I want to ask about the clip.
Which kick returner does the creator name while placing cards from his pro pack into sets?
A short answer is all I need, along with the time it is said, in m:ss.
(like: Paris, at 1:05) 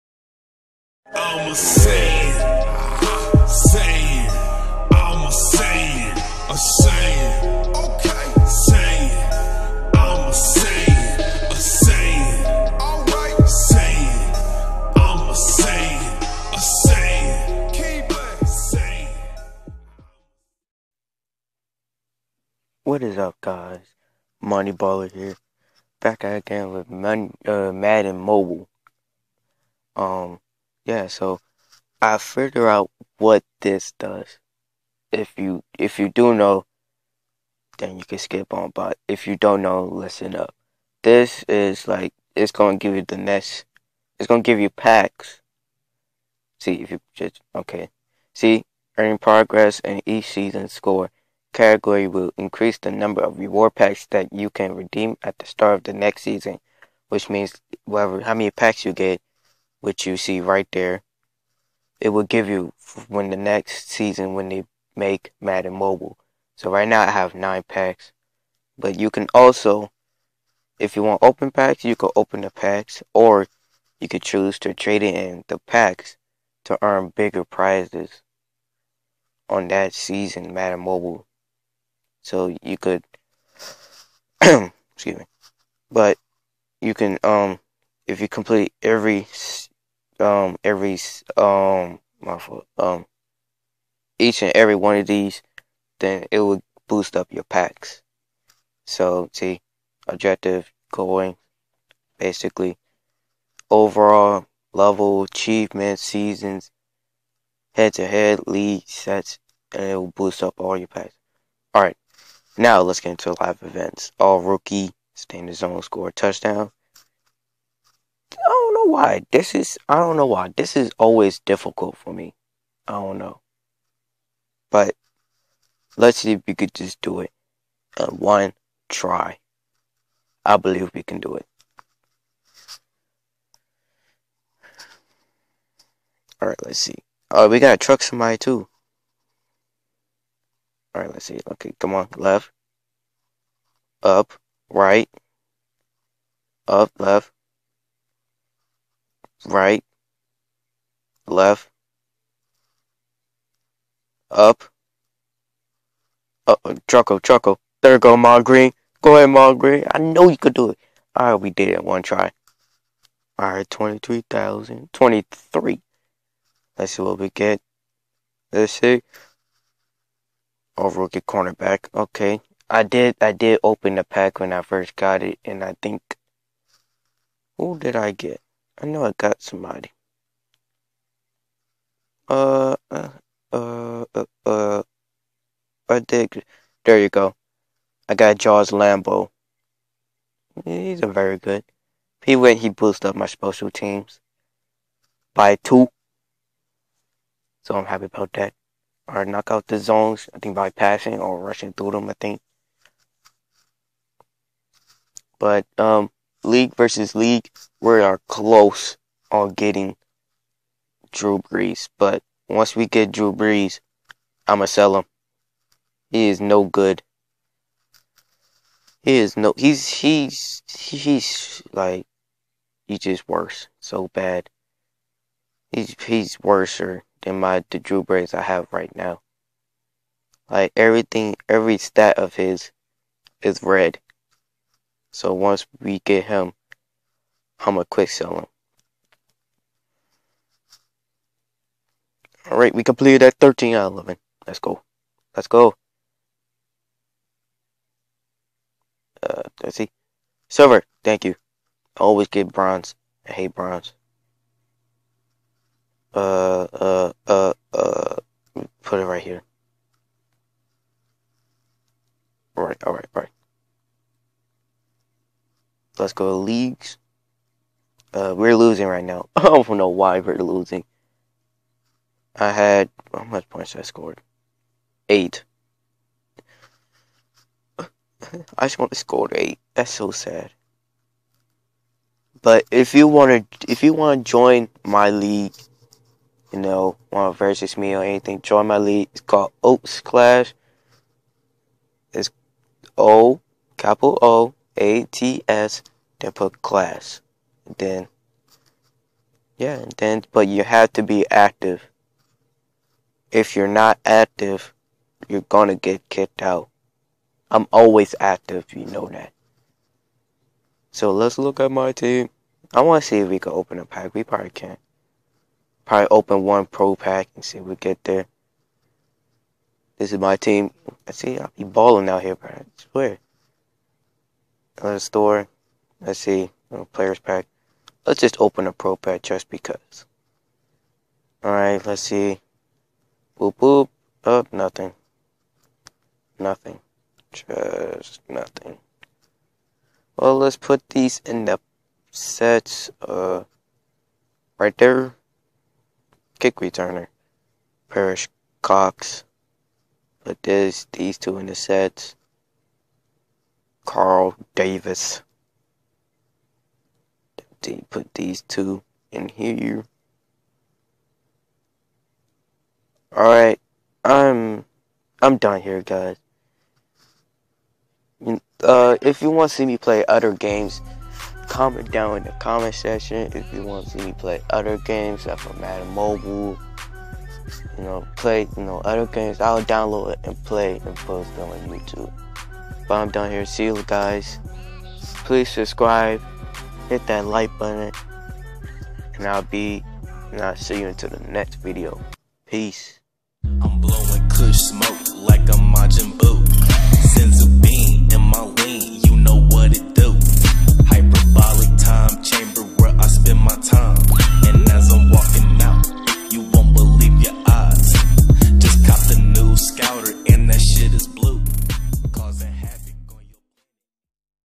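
Perrish Cox, at 5:47.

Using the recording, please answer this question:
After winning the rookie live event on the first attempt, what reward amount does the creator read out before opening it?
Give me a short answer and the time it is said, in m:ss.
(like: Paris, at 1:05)
23,000, at 2:43.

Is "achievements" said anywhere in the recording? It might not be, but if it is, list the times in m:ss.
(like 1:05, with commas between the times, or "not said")
1:45.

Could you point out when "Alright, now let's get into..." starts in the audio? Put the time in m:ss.
1:51.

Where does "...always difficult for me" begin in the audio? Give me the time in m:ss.
2:00.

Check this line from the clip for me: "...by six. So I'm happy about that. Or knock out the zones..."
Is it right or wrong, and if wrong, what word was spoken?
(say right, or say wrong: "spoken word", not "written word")
wrong: "two", not "six".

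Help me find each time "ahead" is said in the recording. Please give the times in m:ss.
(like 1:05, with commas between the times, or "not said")
2:39.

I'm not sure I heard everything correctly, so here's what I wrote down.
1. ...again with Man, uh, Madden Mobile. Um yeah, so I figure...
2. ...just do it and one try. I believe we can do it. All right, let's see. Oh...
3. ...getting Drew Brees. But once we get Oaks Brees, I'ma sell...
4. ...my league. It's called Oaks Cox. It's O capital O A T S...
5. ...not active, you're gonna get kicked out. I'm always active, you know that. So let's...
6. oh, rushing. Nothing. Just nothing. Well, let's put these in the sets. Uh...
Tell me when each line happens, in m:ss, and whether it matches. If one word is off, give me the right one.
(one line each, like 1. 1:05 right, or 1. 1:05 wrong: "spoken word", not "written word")
1. 0:26 right
2. 2:06 right
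3. 3:29 wrong: "Drew", not "Oaks"
4. 4:48 wrong: "Clash", not "Cox"
5. 5:03 right
6. 5:34 wrong: "nothing", not "rushing".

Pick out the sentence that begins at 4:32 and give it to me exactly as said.
I had how much points I scored?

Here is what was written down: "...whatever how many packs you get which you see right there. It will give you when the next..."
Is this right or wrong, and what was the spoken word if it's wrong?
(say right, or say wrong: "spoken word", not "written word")
right.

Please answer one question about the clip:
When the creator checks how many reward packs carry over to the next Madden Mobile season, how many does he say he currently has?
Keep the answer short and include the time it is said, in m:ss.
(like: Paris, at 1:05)
9, at 1:07.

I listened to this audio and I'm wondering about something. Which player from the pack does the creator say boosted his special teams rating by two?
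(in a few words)
Jaws Lambo.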